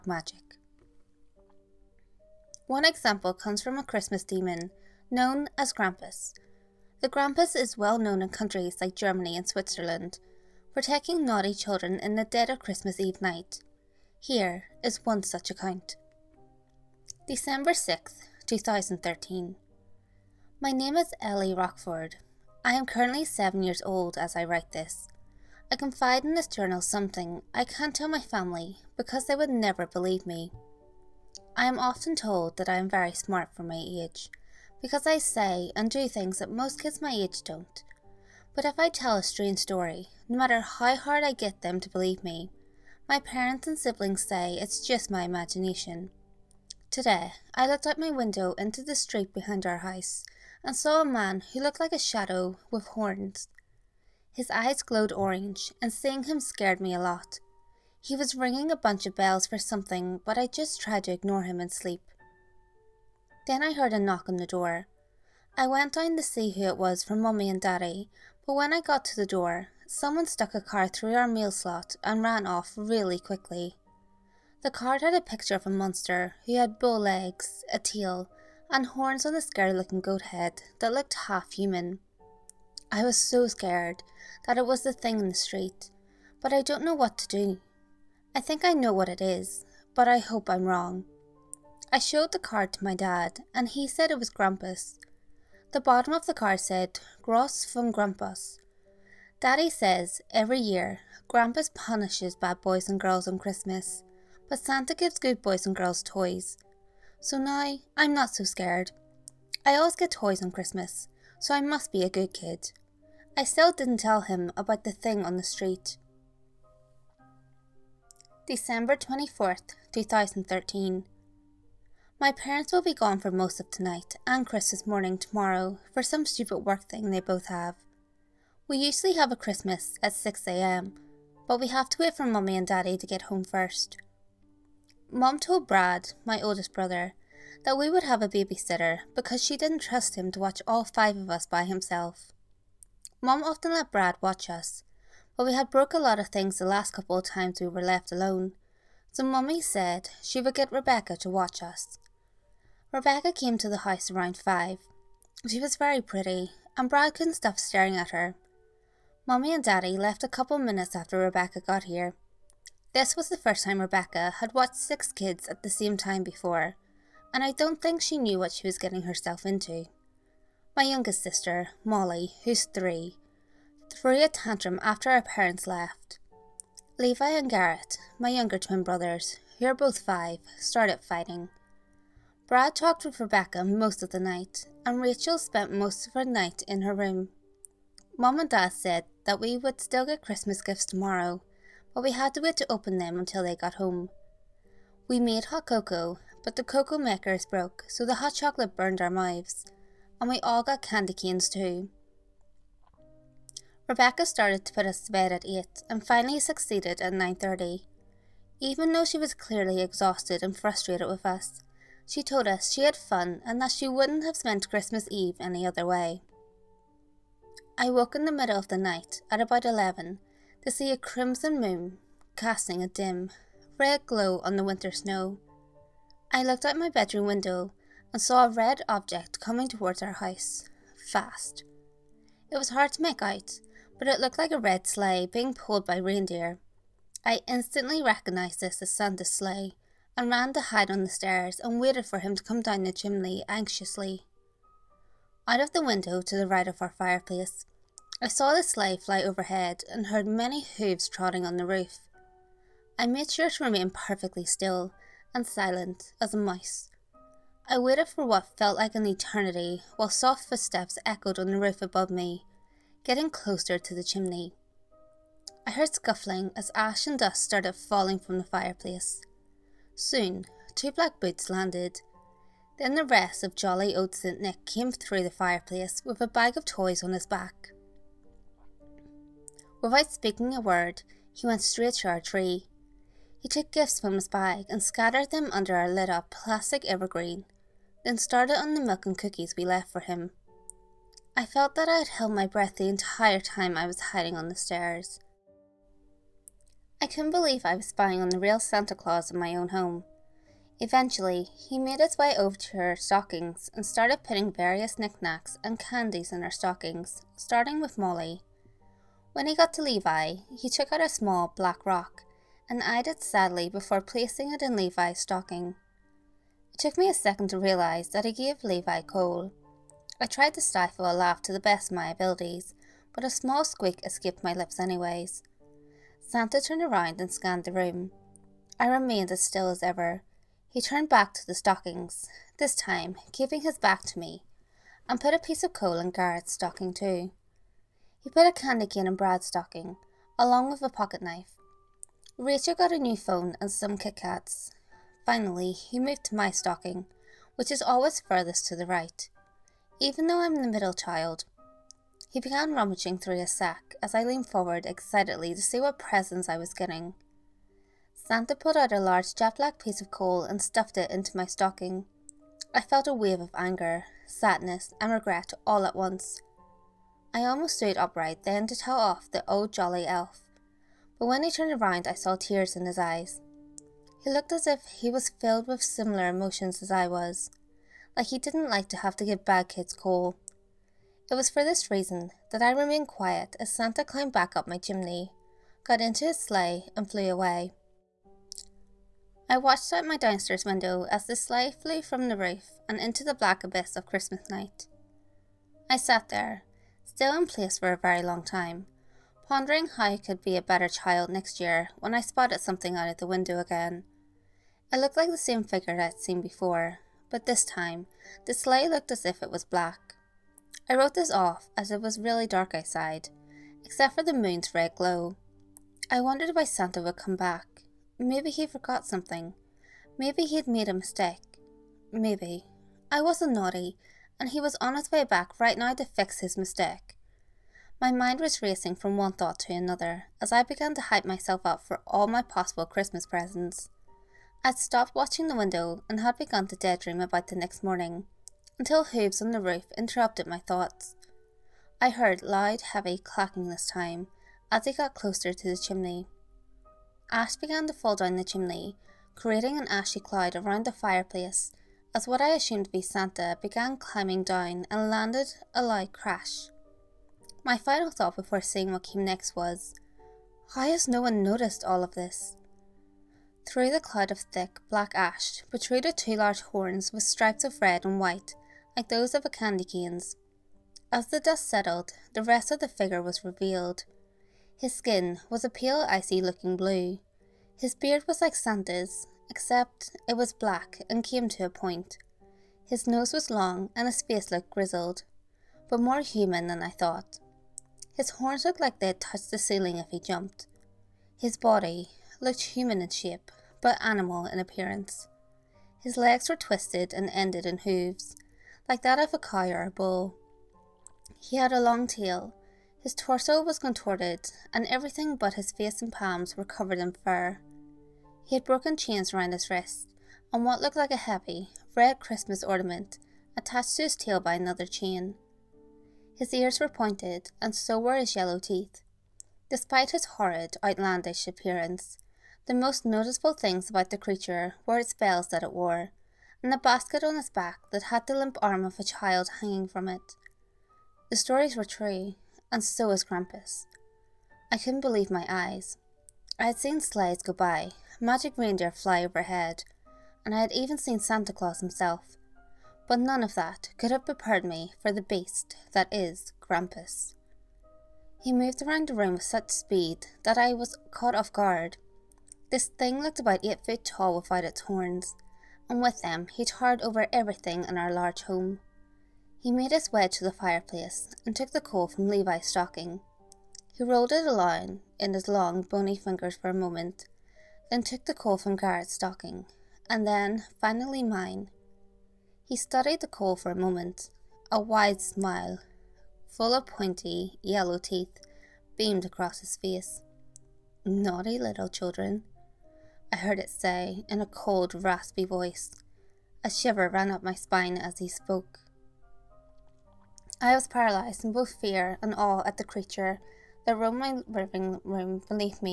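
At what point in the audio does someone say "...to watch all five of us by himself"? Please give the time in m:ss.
2:20.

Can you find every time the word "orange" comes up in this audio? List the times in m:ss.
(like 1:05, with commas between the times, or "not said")
0:55.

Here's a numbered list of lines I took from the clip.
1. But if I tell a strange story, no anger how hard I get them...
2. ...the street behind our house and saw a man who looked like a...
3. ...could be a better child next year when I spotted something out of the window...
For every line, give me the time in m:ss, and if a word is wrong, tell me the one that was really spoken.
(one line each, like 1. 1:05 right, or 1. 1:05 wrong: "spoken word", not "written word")
1. 0:38 wrong: "matter", not "anger"
2. 0:48 right
3. 6:40 right.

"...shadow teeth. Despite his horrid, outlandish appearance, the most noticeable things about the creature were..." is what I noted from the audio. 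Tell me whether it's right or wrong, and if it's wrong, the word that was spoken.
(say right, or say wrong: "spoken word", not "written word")
wrong: "yellow", not "shadow".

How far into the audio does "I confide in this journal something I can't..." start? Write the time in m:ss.
0:25.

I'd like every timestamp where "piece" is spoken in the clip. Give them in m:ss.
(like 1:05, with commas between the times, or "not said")
5:35, 5:59.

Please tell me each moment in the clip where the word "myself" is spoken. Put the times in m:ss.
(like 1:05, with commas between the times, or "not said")
7:11.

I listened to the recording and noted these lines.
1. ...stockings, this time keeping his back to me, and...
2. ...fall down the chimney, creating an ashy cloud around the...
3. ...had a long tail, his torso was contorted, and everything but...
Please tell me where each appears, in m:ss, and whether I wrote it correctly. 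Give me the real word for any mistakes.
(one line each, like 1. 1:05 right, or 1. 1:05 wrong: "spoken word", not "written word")
1. 5:31 right
2. 7:27 right
3. 8:21 right.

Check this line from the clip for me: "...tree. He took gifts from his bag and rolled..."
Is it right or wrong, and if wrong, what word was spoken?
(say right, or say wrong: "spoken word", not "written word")
wrong: "scattered", not "rolled".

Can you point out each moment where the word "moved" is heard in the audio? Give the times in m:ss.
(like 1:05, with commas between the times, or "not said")
5:46, 9:08.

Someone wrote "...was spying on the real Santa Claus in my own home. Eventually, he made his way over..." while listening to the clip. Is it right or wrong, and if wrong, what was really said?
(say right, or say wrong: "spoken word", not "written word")
right.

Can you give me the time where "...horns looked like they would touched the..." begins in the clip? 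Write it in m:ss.
8:08.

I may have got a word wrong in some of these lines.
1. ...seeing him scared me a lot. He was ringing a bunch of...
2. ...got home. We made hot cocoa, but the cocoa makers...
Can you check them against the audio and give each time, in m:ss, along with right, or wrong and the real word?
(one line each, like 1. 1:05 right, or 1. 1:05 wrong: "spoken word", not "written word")
1. 0:55 right
2. 3:13 right.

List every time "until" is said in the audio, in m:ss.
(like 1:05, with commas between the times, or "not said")
3:13, 7:18.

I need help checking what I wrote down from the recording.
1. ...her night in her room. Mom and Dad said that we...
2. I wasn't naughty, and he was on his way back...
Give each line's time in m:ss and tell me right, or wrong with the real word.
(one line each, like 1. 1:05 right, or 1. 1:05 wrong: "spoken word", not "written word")
1. 3:06 right
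2. 7:03 right.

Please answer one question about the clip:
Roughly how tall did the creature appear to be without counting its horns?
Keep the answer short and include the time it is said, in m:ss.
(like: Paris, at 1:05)
8 feet, at 9:13.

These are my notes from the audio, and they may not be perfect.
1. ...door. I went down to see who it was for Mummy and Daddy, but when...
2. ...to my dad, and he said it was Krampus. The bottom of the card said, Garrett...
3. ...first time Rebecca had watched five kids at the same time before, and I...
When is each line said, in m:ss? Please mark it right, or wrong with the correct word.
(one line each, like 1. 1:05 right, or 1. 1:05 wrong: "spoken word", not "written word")
1. 1:04 right
2. 1:32 wrong: "Gross", not "Garrett"
3. 2:43 wrong: "six", not "five".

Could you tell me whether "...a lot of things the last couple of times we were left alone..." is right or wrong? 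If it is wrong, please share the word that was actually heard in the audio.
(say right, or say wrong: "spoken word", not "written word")
right.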